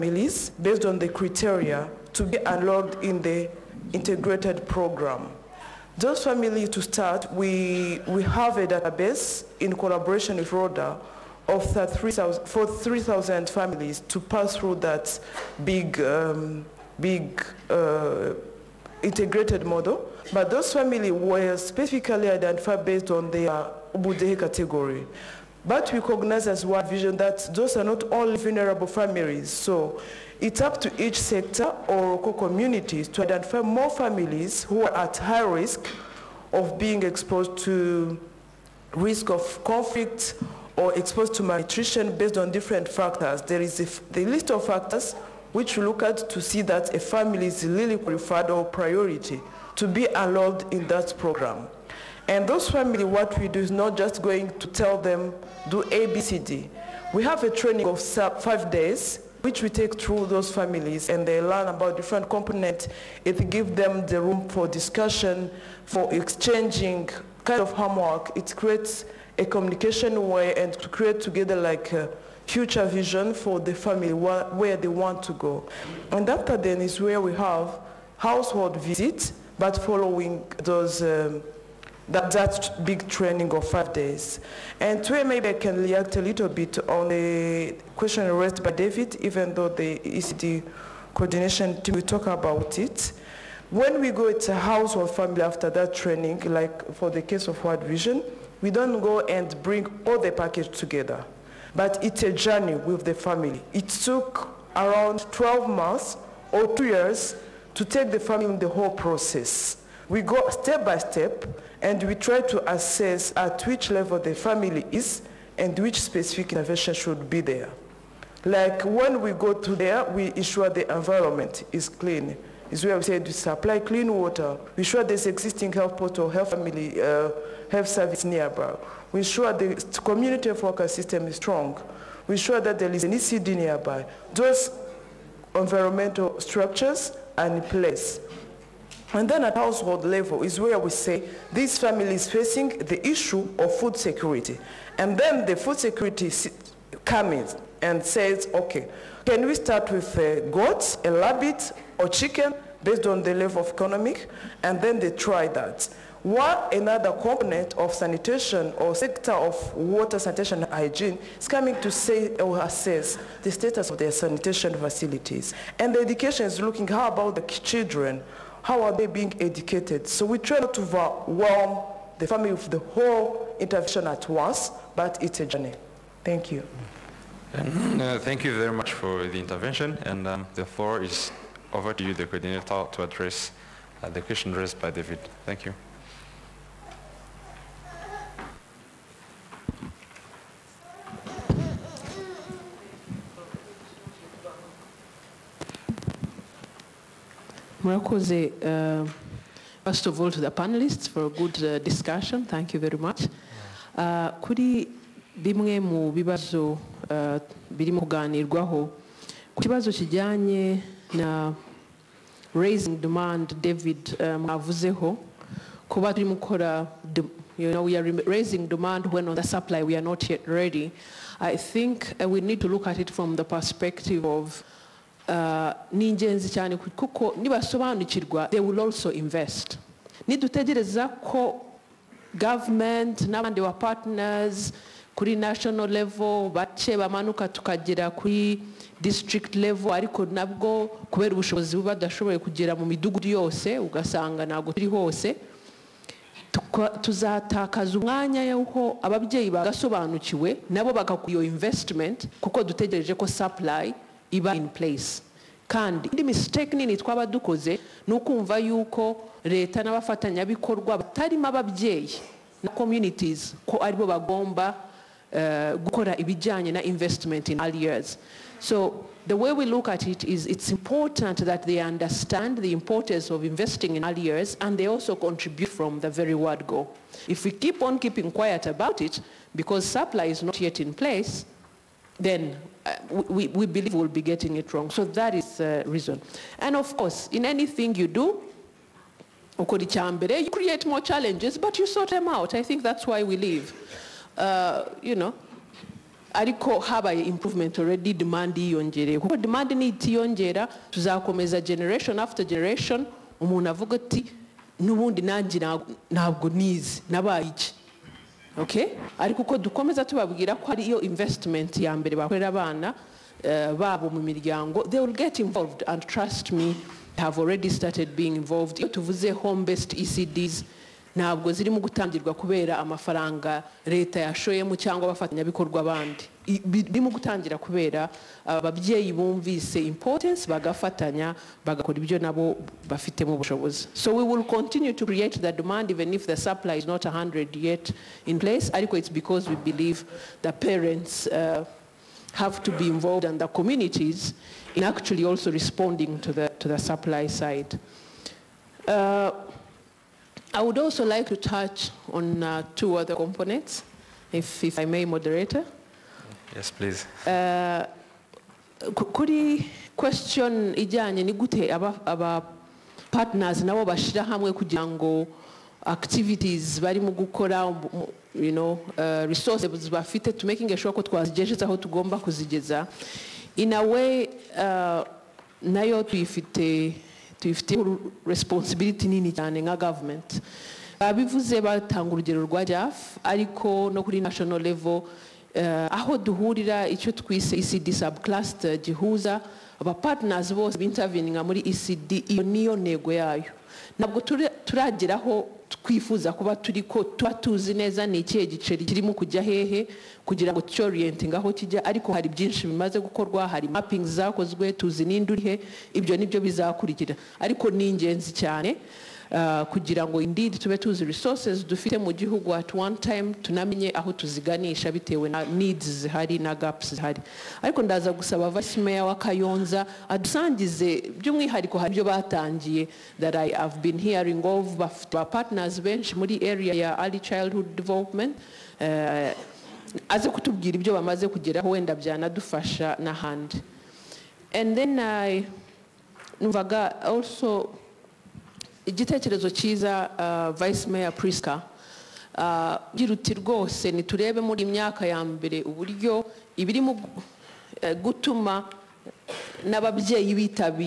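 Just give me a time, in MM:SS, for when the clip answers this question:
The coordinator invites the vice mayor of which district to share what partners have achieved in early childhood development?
06:59.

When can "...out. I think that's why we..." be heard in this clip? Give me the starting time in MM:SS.
04:52.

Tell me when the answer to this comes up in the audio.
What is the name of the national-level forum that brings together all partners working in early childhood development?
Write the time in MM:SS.
06:27.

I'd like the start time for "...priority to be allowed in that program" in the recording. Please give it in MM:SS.
00:48.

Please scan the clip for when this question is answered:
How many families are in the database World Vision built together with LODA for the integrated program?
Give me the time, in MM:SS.
00:12.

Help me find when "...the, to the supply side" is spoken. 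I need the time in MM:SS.
05:46.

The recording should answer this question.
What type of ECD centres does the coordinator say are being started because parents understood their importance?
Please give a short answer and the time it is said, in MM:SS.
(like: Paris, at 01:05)
Home based ECDs, at 05:19.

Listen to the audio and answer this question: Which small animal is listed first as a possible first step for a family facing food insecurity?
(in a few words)
Goats.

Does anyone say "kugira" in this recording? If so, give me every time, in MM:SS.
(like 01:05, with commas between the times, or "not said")
06:04, 06:40, 06:49.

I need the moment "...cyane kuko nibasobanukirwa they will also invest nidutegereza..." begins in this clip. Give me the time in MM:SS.
03:46.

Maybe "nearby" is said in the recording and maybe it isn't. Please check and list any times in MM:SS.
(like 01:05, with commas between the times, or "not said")
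02:08, 02:13.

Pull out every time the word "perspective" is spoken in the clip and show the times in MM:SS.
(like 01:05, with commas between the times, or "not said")
03:43.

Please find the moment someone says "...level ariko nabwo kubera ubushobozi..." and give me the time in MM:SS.
03:59.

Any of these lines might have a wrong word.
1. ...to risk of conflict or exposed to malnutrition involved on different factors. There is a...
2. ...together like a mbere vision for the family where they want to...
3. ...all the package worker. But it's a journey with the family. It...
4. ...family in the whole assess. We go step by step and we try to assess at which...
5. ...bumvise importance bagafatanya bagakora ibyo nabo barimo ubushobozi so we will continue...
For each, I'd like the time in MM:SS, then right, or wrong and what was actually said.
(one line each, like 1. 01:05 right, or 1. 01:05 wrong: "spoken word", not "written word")
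1. 00:37 wrong: "based", not "involved"
2. 01:11 wrong: "future", not "mbere"
3. 01:40 wrong: "together", not "worker"
4. 01:48 wrong: "process", not "assess"
5. 05:29 wrong: "bafitemo", not "barimo".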